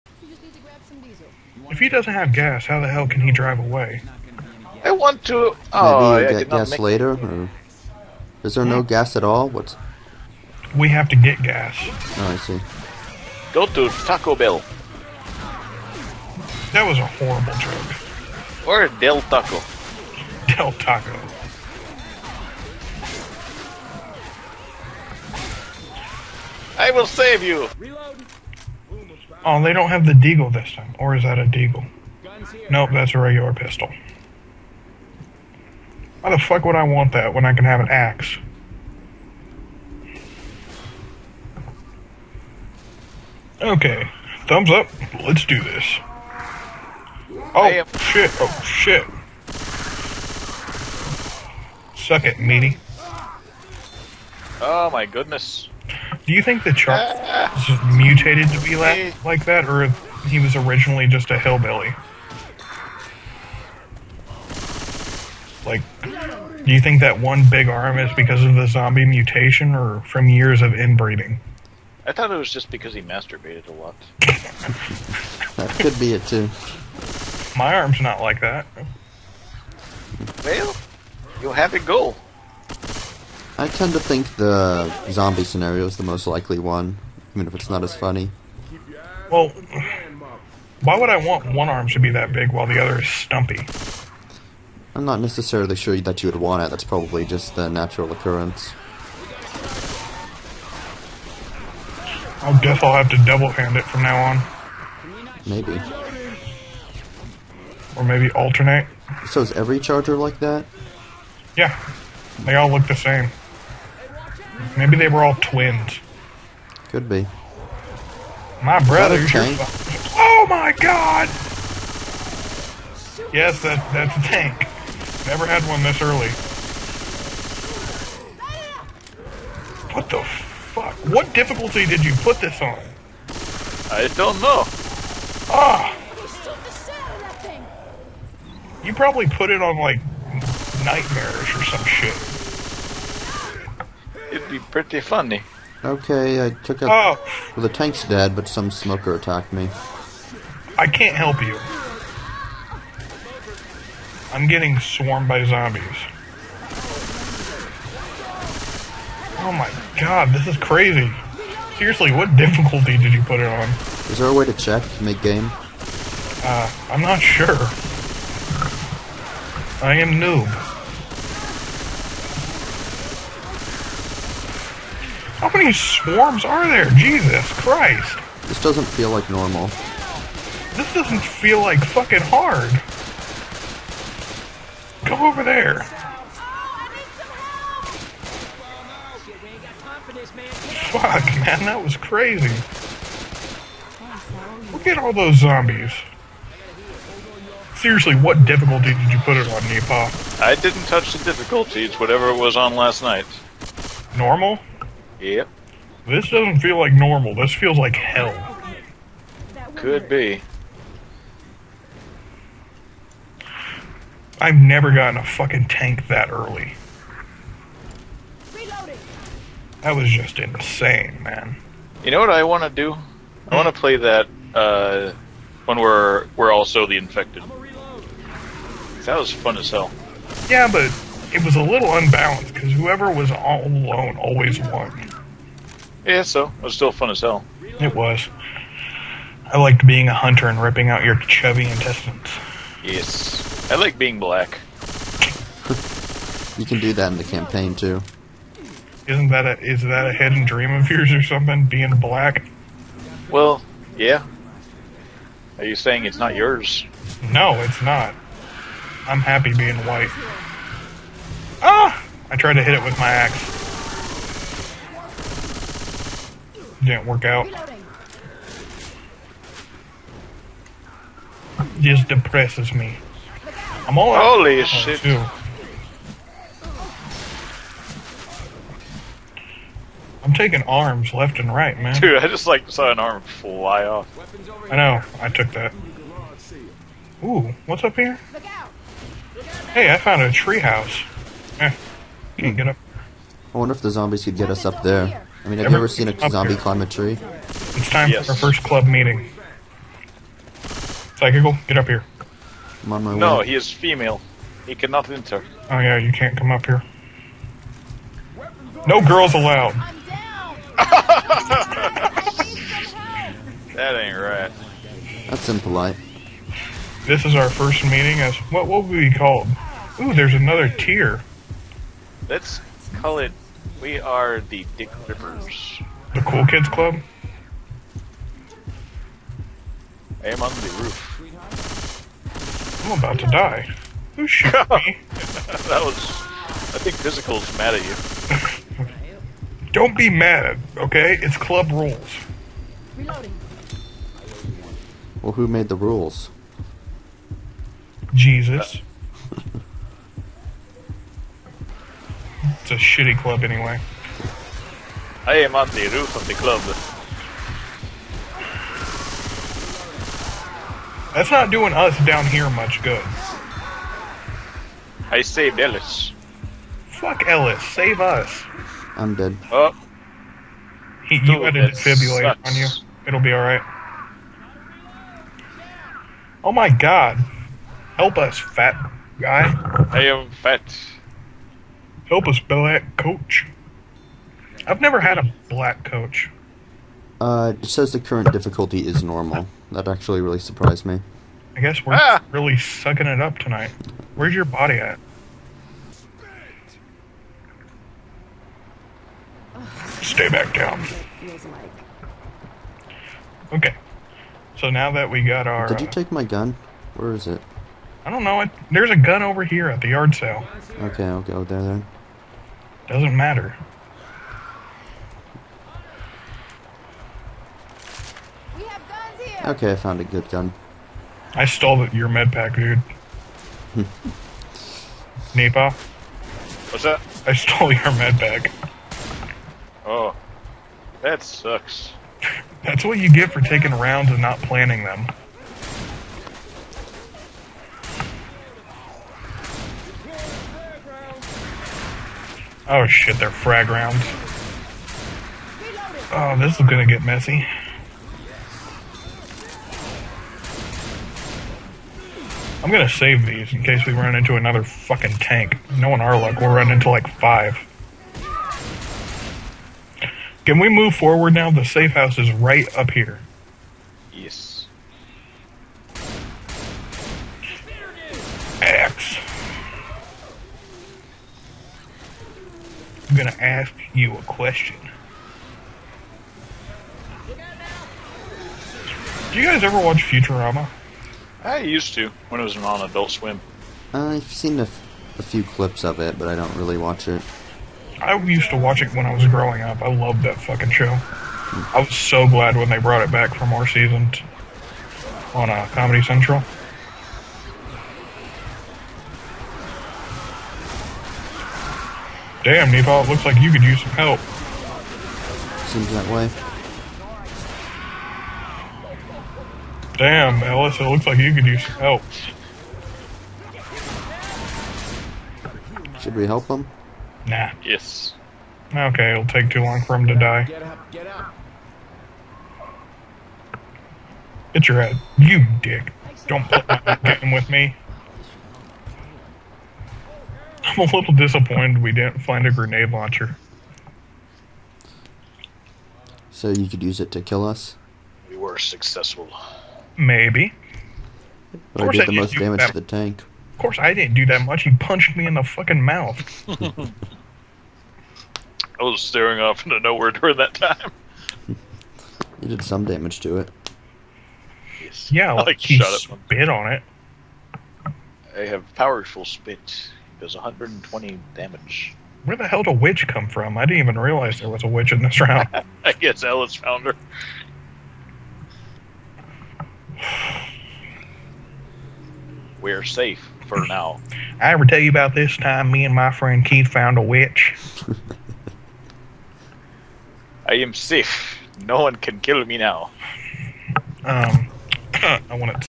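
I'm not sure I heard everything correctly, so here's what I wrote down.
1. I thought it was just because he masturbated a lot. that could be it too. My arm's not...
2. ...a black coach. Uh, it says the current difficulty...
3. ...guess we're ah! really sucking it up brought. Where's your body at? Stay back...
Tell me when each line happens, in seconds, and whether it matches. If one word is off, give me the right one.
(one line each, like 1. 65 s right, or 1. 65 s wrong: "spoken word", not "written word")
1. 72 s right
2. 385 s right
3. 391 s wrong: "tonight", not "brought".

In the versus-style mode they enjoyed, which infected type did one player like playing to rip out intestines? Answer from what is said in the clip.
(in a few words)
hunter.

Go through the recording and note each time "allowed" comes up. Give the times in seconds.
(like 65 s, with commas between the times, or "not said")
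309 s.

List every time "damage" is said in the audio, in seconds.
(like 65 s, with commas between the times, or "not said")
542 s, 552 s, 561 s.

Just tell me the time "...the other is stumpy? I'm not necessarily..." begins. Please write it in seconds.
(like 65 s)
92 s.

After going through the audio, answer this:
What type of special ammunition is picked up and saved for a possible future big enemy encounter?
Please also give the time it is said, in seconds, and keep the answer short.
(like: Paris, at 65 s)
frag rounds, at 443 s.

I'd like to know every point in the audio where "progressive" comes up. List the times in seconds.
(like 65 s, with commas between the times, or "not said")
not said.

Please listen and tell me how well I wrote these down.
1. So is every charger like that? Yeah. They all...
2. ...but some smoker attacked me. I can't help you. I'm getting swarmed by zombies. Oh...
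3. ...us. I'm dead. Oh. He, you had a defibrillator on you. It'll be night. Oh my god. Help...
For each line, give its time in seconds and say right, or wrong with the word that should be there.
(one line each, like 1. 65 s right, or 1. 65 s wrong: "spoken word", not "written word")
1. 109 s right
2. 148 s right
3. 367 s wrong: "alright", not "night".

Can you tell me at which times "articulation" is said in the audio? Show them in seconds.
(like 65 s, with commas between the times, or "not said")
not said.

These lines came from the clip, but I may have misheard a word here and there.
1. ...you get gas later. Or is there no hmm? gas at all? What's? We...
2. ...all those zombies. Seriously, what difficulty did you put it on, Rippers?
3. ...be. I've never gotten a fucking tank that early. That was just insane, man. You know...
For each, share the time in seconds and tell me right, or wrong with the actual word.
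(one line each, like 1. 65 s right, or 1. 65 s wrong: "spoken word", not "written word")
1. 6 s right
2. 194 s wrong: "NiPah", not "Rippers"
3. 210 s right.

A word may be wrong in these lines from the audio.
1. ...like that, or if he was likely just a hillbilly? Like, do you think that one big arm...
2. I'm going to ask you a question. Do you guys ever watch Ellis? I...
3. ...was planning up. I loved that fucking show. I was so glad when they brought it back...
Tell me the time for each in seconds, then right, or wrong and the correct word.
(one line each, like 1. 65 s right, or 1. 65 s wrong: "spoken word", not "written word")
1. 59 s wrong: "originally", not "likely"
2. 473 s wrong: "Futurama", not "Ellis"
3. 489 s wrong: "growing", not "planning".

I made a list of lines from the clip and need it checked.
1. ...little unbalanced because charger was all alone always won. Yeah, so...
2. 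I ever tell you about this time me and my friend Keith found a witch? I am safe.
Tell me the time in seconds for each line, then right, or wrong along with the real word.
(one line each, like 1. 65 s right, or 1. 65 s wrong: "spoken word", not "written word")
1. 231 s wrong: "whoever", not "charger"
2. 574 s right.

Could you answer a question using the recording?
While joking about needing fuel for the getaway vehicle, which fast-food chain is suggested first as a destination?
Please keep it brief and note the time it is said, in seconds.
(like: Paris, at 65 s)
Taco Bell, at 13 s.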